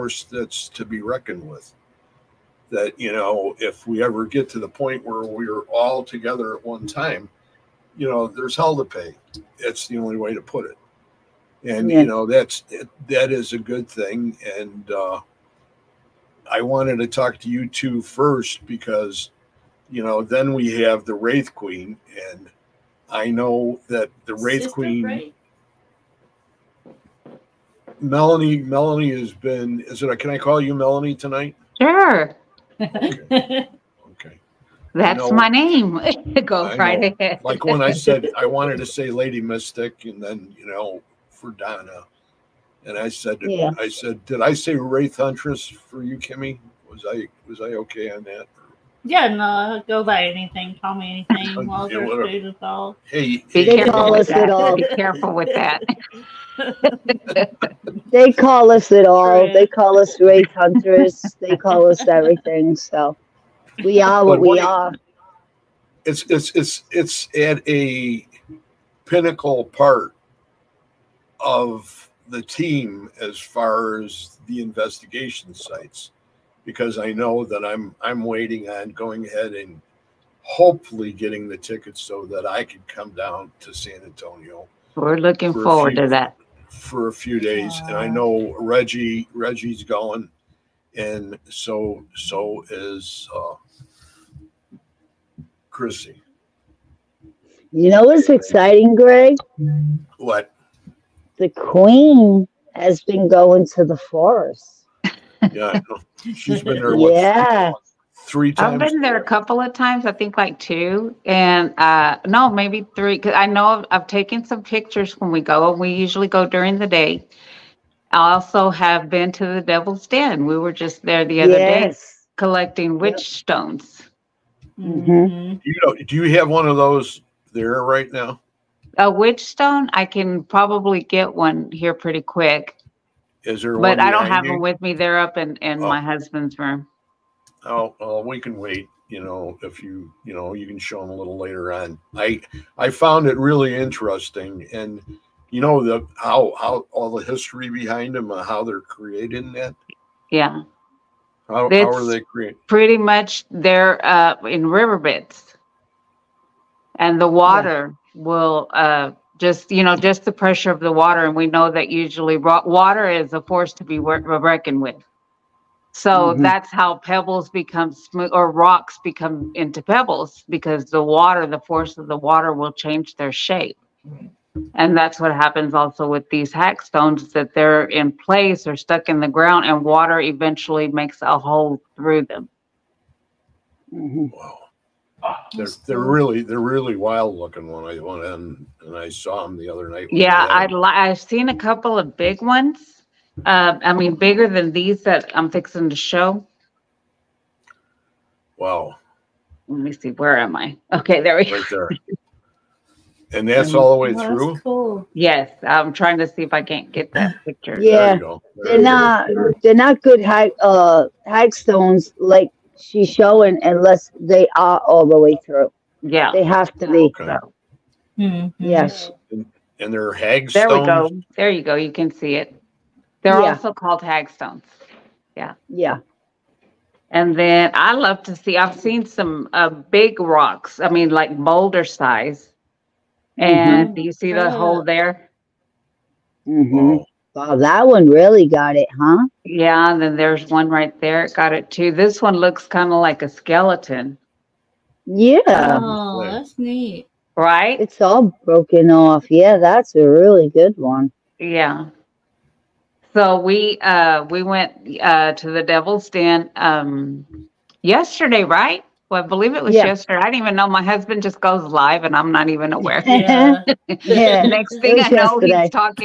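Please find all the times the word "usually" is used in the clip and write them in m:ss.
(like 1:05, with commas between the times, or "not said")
1:55, 2:41.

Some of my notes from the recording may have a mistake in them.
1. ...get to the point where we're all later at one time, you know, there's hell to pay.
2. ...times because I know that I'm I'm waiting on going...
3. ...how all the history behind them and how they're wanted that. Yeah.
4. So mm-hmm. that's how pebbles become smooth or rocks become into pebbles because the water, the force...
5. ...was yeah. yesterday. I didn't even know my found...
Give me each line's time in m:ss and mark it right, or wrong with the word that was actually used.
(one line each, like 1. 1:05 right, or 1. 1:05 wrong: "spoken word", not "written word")
1. 0:04 wrong: "together", not "later"
2. 1:15 wrong: "sites", not "times"
3. 2:26 wrong: "created", not "wanted"
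4. 2:45 right
5. 4:19 wrong: "husband", not "found".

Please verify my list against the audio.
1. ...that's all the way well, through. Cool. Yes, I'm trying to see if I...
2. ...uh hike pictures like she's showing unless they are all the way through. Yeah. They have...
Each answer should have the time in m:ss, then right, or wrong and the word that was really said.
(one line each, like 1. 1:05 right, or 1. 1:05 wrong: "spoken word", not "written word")
1. 3:23 right
2. 3:30 wrong: "stones", not "pictures".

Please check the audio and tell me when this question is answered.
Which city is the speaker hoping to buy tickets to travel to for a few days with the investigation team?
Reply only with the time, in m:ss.
1:23.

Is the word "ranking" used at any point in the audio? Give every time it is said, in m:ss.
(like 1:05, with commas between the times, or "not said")
not said.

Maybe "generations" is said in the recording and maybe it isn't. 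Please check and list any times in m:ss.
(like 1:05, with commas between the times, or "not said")
not said.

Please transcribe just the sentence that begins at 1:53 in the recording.
Cause I know I've, I've taken some pictures when we go.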